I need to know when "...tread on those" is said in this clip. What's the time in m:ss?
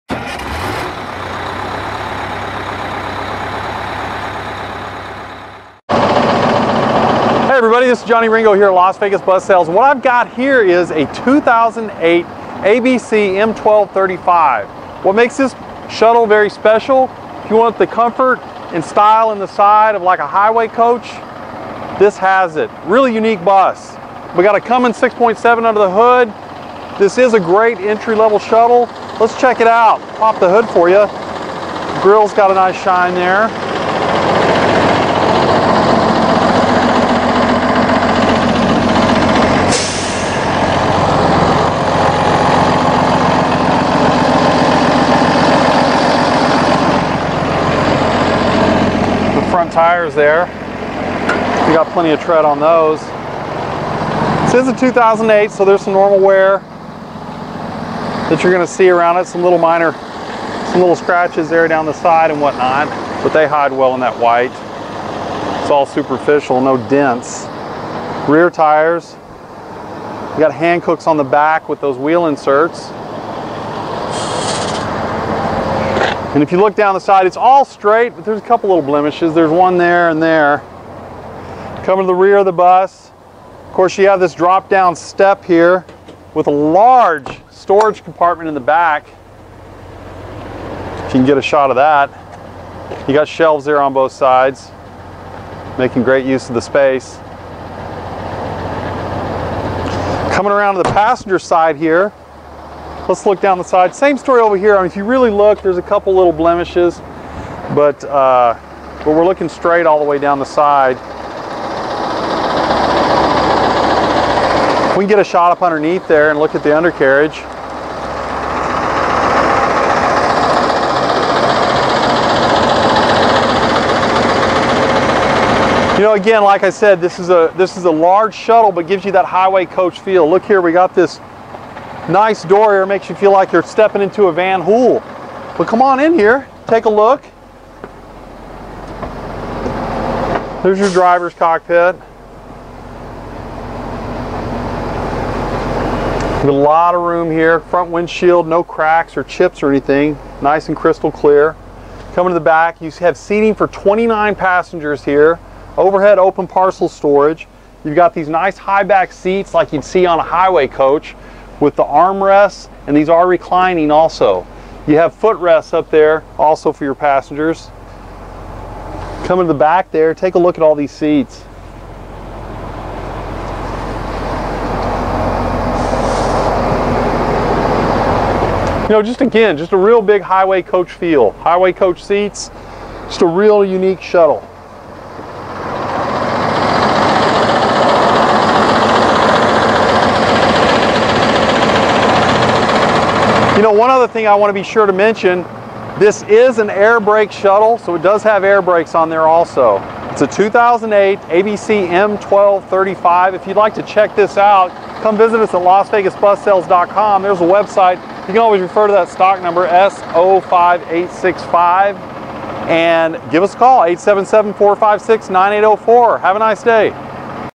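0:52.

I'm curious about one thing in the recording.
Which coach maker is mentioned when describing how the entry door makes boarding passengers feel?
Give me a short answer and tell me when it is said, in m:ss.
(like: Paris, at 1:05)
Van Hool, at 2:14.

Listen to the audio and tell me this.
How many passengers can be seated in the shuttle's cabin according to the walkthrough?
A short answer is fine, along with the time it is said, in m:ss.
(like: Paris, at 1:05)
29, at 2:33.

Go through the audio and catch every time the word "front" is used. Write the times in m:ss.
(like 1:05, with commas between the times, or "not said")
0:49, 2:27.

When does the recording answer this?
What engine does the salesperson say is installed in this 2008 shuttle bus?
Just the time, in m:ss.
0:24.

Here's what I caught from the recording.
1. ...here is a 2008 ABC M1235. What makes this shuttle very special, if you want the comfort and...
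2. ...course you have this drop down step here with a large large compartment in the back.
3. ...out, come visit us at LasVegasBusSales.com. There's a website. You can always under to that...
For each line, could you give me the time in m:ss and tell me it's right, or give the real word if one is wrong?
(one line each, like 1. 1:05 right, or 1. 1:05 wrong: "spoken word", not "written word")
1. 0:10 right
2. 1:23 wrong: "storage", not "large"
3. 3:24 wrong: "refer", not "under".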